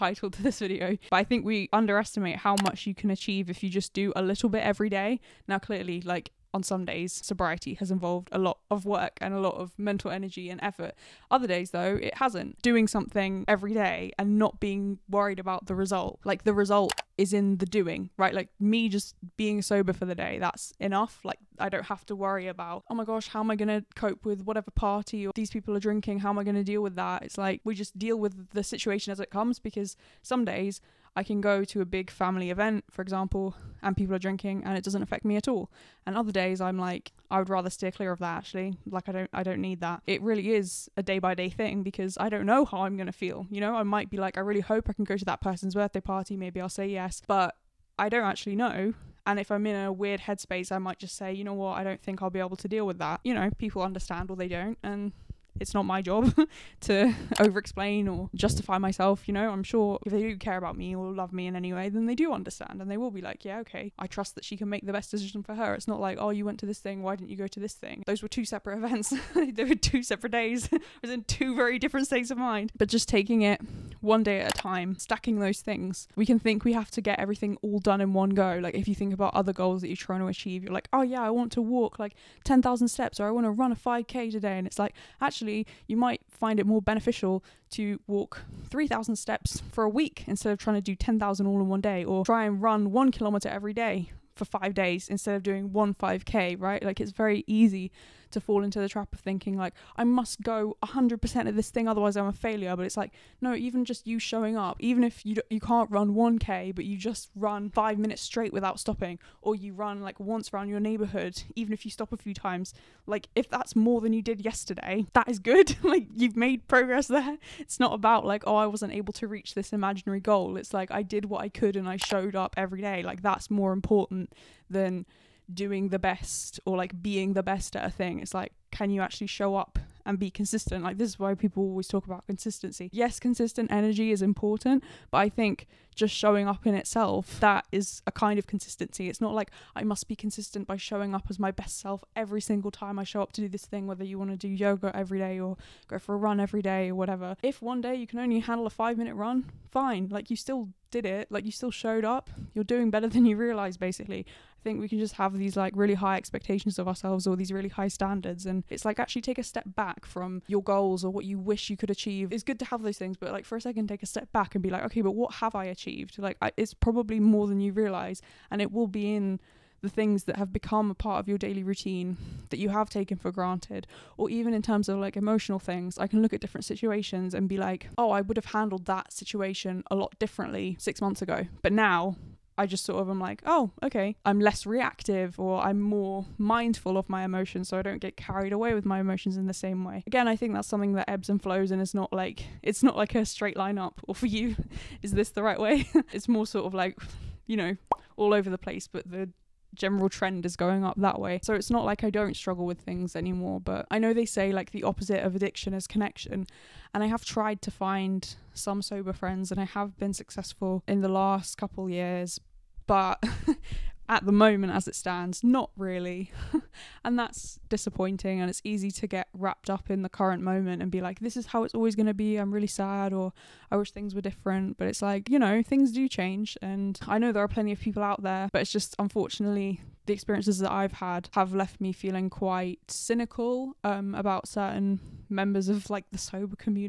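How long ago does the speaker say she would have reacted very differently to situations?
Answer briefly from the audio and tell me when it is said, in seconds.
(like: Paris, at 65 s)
6 months, at 180 s.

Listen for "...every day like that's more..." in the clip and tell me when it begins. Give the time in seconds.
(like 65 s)
122 s.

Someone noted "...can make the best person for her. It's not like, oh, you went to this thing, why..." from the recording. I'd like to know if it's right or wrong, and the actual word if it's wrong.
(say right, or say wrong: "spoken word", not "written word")
wrong: "decision", not "person".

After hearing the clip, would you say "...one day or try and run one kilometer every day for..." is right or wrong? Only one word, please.
right.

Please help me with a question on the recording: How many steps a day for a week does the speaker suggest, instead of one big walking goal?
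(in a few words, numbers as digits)
3,000.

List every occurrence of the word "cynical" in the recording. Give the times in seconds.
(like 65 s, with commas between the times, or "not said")
232 s.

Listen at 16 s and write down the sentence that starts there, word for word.
Like, the result is in the doing, right?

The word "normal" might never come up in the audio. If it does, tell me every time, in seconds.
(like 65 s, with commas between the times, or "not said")
not said.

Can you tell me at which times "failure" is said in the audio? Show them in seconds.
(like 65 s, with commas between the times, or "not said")
102 s.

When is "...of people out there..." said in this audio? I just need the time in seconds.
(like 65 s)
227 s.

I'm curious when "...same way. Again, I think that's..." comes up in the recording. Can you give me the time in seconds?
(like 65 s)
189 s.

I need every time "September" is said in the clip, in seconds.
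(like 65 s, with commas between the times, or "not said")
not said.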